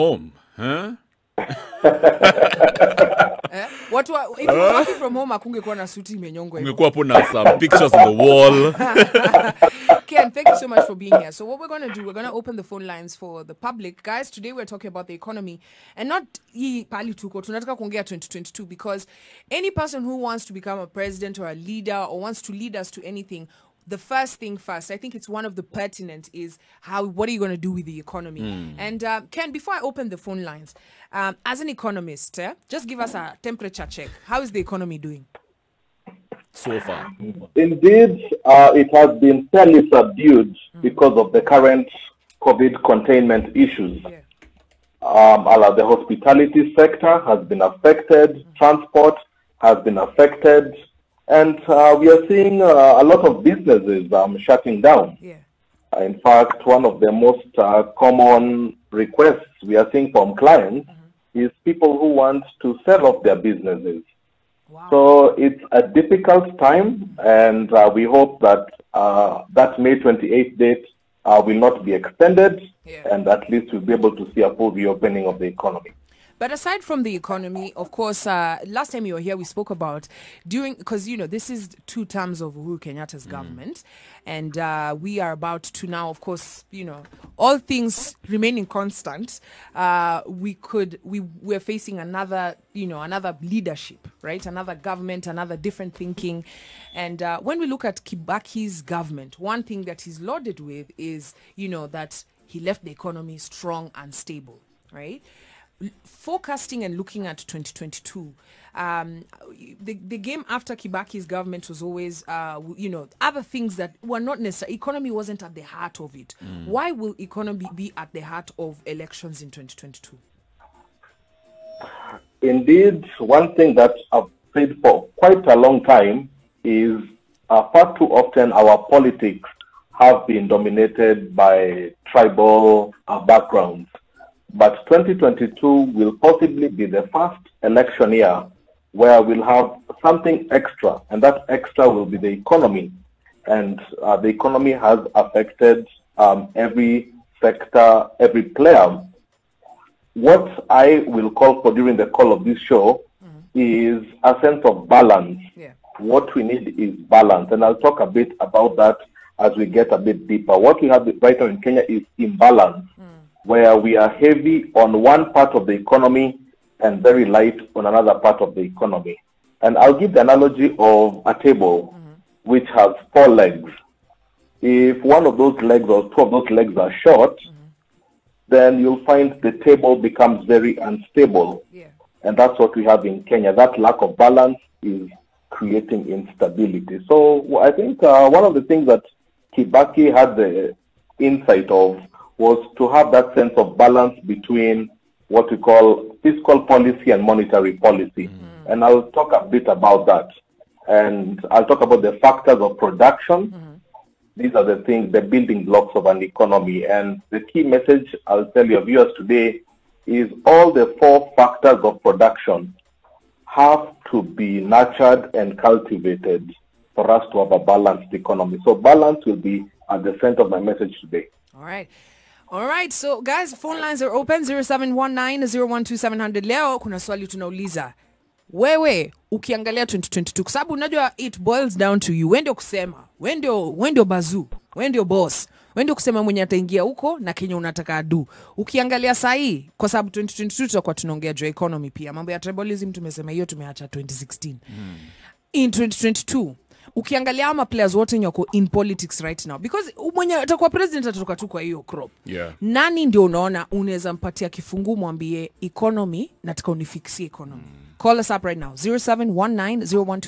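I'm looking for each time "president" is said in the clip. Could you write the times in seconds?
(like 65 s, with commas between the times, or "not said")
20 s, 250 s.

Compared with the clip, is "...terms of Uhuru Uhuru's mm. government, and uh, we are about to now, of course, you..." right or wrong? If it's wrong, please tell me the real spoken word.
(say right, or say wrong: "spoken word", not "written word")
wrong: "Kenyatta", not "Uhuru".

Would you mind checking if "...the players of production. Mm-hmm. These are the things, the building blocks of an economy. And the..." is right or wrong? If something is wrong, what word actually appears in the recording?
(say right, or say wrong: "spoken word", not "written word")
wrong: "factors", not "players".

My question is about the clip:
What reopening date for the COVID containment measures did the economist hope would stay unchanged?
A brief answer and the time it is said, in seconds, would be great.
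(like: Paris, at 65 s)
May 28th, at 69 s.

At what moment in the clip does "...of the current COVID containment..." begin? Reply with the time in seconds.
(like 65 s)
41 s.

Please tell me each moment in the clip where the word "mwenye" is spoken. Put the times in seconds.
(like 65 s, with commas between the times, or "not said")
236 s, 250 s.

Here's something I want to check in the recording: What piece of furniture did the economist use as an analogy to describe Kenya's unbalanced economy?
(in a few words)
A table.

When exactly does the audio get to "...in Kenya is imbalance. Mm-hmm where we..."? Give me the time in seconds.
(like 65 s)
161 s.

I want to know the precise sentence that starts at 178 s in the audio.
then you'll find the table becomes very unstable.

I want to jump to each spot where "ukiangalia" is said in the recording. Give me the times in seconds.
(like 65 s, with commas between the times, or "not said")
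229 s, 238 s, 246 s.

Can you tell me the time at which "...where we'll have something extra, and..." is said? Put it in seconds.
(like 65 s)
138 s.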